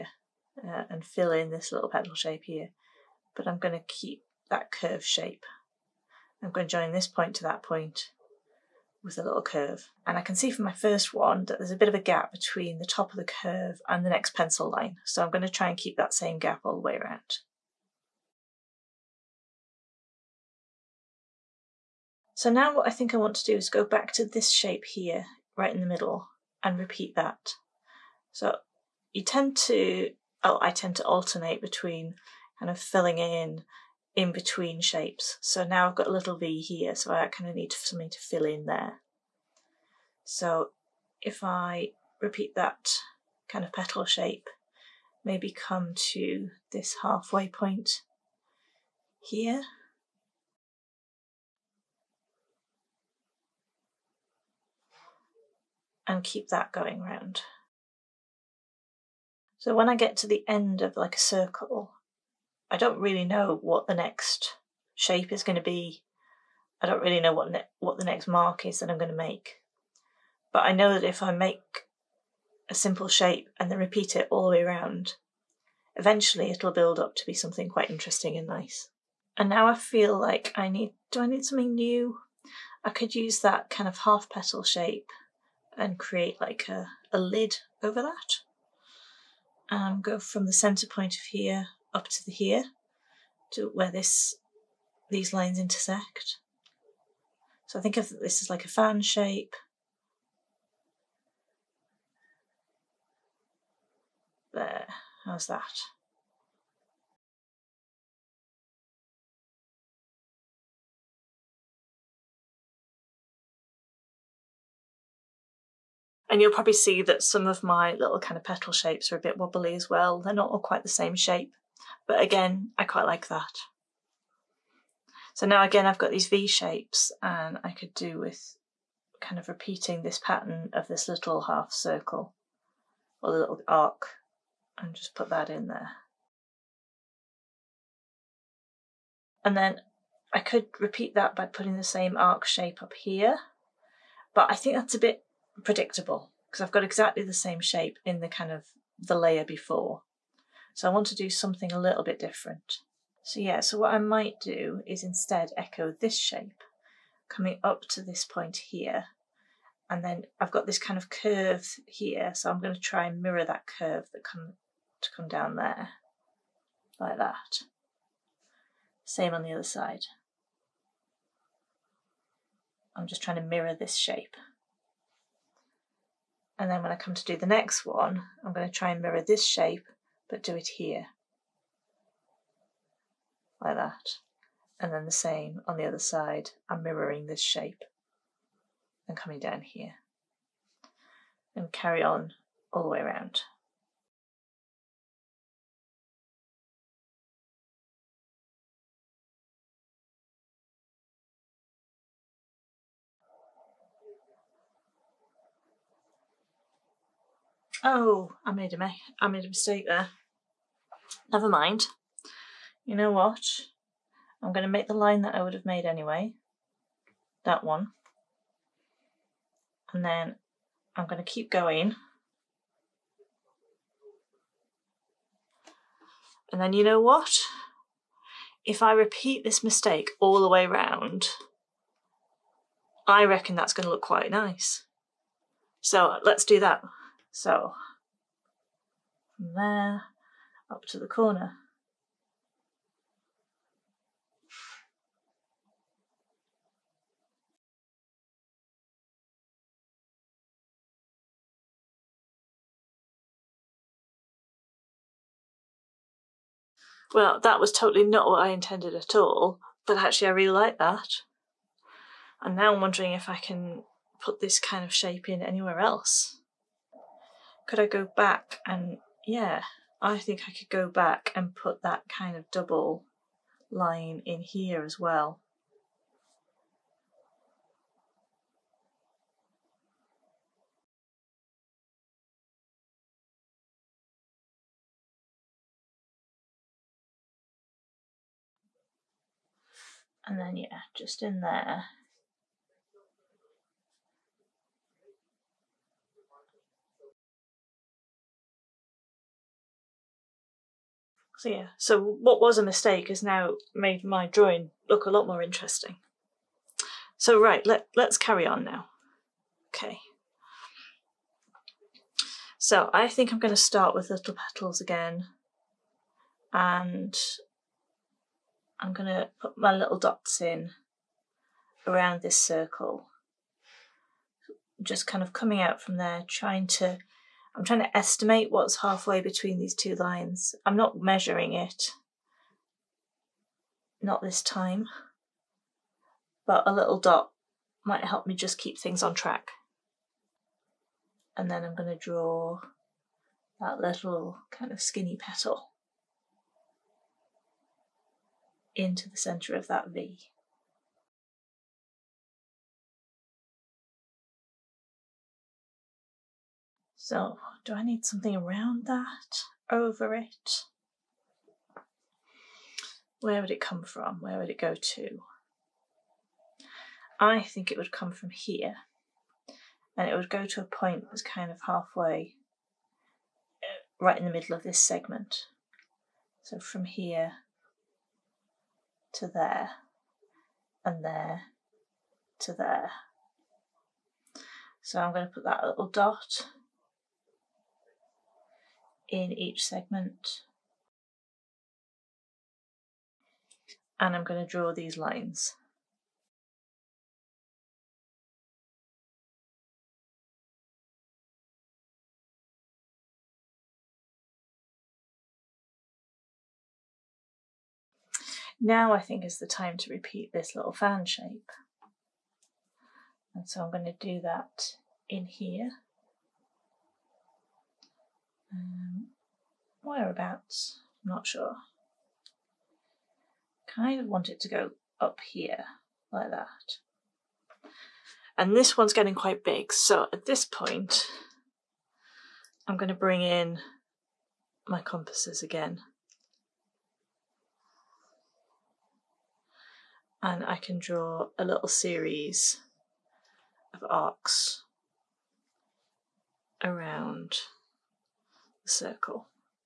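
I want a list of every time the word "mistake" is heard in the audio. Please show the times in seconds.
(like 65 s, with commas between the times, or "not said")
209 s, 229 s, 302 s.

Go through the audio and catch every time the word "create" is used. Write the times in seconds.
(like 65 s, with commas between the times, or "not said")
85 s.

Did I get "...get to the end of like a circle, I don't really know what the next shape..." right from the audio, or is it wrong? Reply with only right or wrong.
right.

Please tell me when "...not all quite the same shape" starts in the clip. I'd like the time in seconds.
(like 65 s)
120 s.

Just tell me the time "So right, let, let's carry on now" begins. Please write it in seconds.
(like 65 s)
307 s.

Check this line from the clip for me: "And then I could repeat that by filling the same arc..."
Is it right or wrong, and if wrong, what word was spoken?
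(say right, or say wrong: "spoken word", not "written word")
wrong: "putting", not "filling".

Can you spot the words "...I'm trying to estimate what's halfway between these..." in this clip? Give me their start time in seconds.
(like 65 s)
327 s.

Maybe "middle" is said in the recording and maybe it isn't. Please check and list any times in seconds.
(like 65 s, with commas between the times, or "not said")
25 s, 374 s.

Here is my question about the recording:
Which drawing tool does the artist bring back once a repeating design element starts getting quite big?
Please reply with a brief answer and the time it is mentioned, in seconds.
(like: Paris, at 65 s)
compasses, at 434 s.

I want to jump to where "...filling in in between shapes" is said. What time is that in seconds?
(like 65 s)
32 s.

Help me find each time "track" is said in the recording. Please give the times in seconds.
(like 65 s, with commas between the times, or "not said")
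339 s.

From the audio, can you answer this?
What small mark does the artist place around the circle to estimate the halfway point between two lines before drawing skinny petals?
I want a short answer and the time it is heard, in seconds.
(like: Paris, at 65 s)
dots, at 319 s.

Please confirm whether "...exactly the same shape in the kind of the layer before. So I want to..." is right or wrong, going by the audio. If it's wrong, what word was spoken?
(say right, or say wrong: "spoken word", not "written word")
right.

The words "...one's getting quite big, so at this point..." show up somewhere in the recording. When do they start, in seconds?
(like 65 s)
428 s.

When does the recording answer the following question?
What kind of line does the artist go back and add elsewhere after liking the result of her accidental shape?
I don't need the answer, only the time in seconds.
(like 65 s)
272 s.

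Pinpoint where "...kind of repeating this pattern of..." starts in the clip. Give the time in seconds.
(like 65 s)
129 s.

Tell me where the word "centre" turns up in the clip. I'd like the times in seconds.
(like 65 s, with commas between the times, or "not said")
90 s, 349 s.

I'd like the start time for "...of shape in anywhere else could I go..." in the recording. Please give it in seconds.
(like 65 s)
264 s.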